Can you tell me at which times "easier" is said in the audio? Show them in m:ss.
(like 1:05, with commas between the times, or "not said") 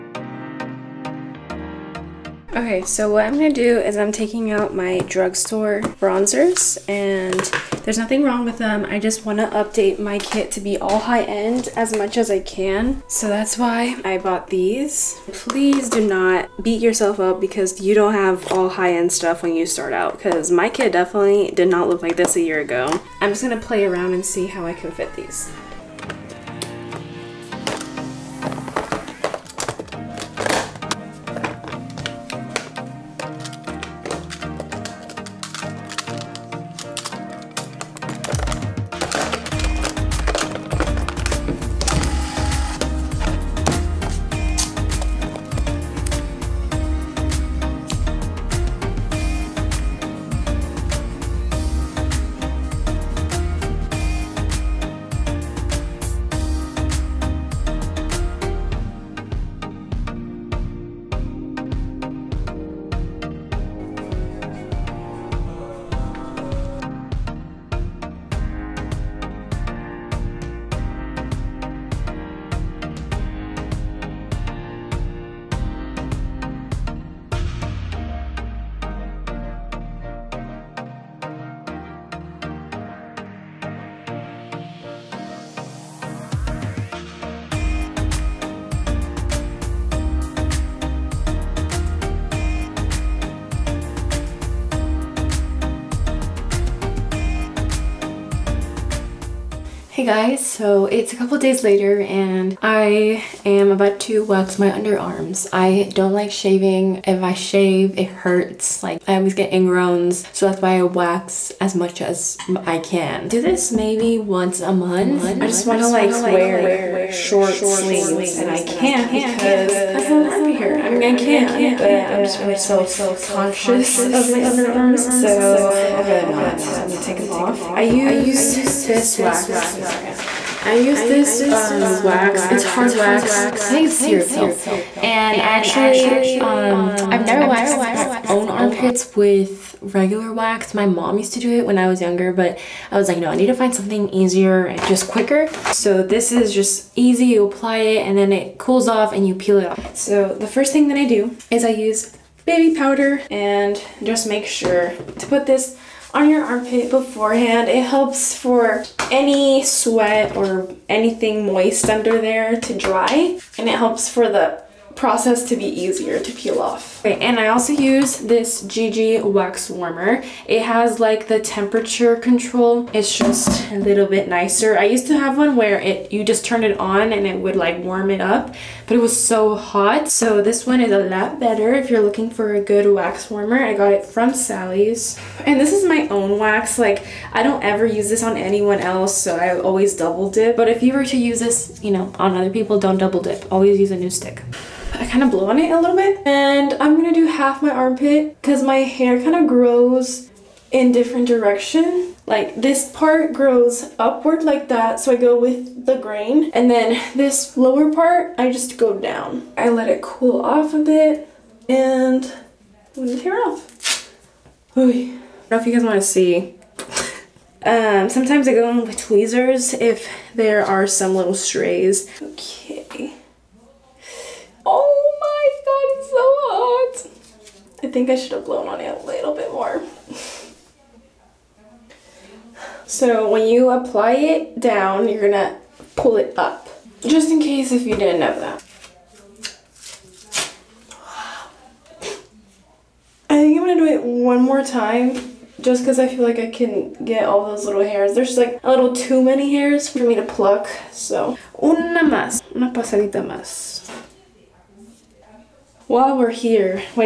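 2:24, 2:45.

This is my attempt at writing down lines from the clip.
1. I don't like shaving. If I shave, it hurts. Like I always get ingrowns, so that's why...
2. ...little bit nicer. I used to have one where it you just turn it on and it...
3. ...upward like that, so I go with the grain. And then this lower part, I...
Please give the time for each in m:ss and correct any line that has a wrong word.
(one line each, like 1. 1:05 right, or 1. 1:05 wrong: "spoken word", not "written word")
1. 1:45 right
2. 2:53 right
3. 3:24 right.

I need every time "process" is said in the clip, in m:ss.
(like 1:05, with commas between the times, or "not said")
2:44.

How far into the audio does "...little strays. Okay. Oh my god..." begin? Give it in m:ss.
3:41.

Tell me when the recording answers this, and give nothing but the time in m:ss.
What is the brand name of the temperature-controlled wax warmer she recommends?
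2:48.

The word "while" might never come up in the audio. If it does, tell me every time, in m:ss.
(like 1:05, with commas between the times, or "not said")
4:15.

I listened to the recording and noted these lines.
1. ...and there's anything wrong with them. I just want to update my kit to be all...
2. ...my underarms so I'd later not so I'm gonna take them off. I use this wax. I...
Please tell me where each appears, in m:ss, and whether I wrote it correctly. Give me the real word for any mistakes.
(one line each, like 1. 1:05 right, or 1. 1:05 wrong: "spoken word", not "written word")
1. 0:06 wrong: "nothing", not "anything"
2. 2:04 wrong: "rather", not "later".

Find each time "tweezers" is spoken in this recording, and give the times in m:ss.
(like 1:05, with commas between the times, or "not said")
3:38.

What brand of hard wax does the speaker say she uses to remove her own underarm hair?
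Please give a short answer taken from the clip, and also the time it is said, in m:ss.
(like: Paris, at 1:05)
Cirepil, at 2:14.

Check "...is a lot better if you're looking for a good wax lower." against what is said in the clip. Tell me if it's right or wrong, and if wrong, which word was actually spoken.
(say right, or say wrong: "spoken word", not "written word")
wrong: "warmer", not "lower".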